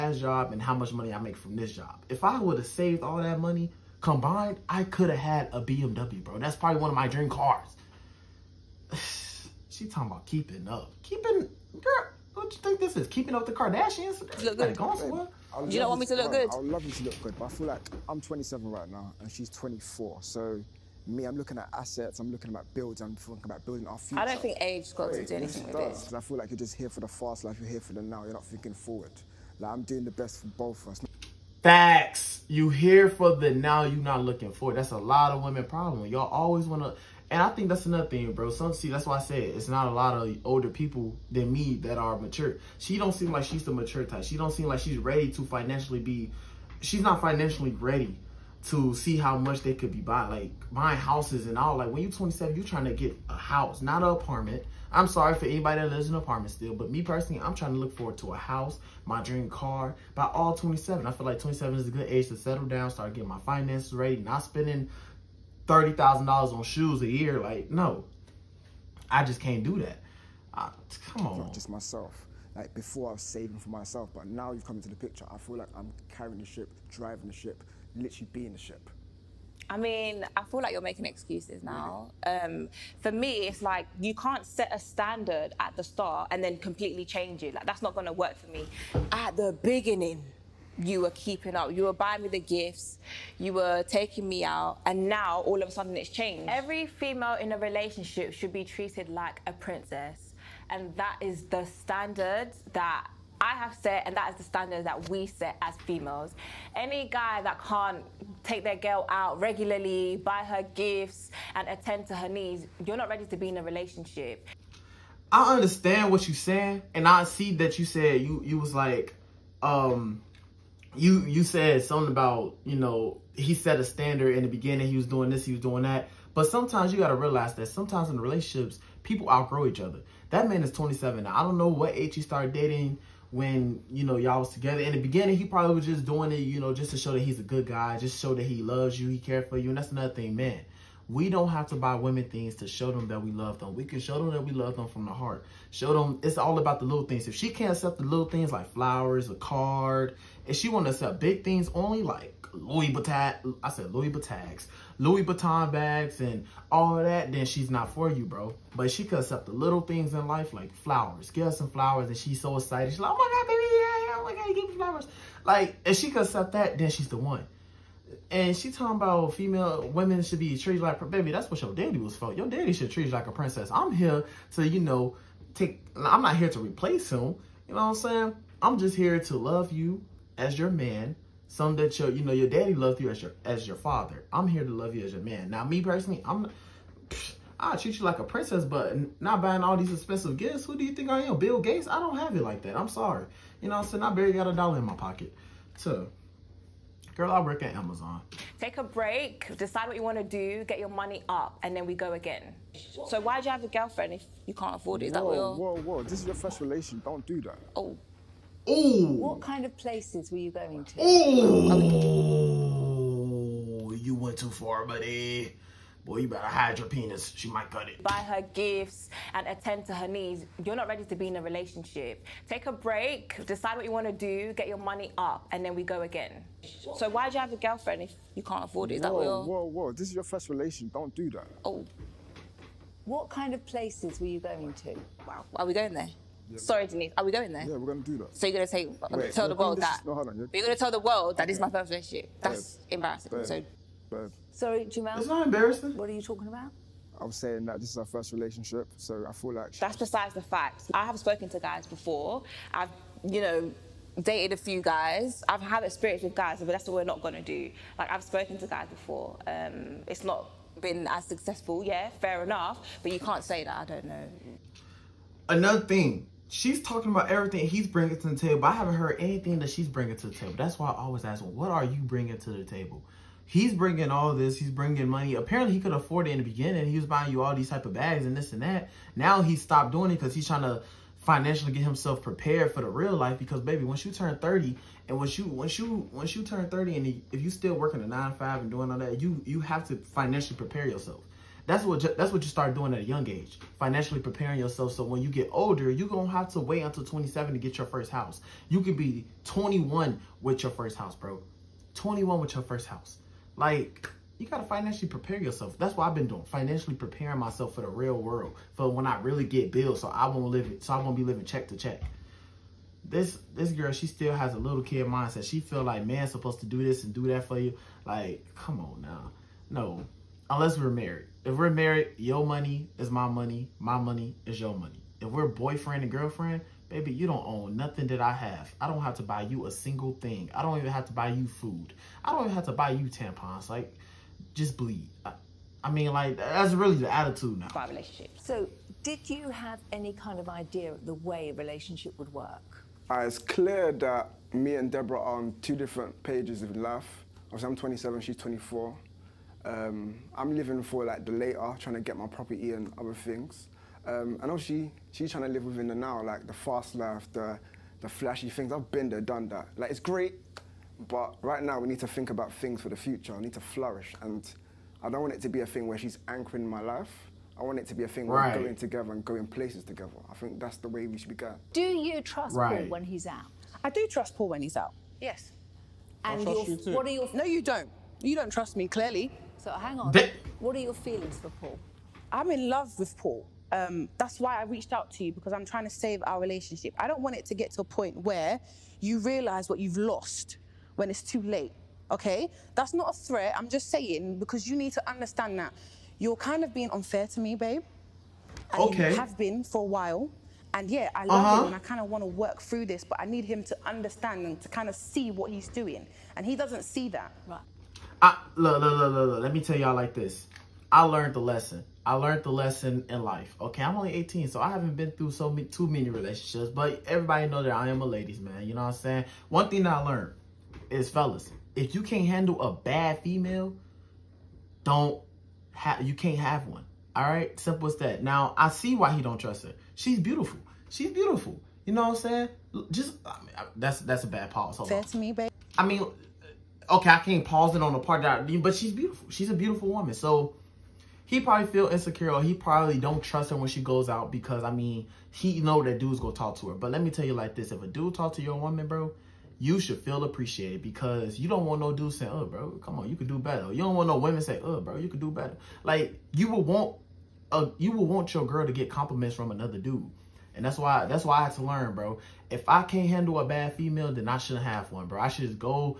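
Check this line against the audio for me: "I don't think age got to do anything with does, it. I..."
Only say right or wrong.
right.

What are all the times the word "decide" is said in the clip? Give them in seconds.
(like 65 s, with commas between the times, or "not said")
199 s, 223 s.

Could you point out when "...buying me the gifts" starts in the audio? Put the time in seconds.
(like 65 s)
91 s.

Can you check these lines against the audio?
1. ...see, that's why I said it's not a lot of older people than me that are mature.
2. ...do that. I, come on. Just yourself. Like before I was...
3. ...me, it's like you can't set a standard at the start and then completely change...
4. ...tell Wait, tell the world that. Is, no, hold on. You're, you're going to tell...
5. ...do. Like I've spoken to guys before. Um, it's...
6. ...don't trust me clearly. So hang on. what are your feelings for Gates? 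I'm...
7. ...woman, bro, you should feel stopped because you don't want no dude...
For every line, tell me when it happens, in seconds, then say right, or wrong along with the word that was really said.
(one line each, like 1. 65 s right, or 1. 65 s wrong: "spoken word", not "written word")
1. 38 s right
2. 69 s wrong: "myself", not "yourself"
3. 83 s right
4. 238 s right
5. 257 s right
6. 378 s wrong: "Paul", not "Gates"
7. 448 s wrong: "appreciated", not "stopped".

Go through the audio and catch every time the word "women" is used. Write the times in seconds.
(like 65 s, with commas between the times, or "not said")
35 s, 141 s, 169 s, 454 s.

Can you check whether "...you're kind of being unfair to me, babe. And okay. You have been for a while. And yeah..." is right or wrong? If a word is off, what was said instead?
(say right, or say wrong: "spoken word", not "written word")
right.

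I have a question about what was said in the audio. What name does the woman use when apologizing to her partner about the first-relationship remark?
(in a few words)
Jamal.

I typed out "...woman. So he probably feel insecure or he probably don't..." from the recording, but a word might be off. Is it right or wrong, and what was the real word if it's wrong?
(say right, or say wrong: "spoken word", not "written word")
right.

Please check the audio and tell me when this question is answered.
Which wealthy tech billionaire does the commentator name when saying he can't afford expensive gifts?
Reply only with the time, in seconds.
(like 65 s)
191 s.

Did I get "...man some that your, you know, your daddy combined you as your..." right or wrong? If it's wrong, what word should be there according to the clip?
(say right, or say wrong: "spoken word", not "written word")
wrong: "loved", not "combined".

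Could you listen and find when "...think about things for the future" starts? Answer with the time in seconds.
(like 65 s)
362 s.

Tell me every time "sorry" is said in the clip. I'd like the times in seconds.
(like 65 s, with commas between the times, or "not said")
55 s, 192 s, 236 s, 244 s.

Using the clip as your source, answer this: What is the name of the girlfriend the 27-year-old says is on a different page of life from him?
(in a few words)
Deborah.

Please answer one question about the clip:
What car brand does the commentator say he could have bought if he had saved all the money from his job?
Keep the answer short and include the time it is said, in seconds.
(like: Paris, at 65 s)
BMW, at 5 s.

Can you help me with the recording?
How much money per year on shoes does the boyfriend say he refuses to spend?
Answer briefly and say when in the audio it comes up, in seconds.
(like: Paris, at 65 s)
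$30,000, at 65 s.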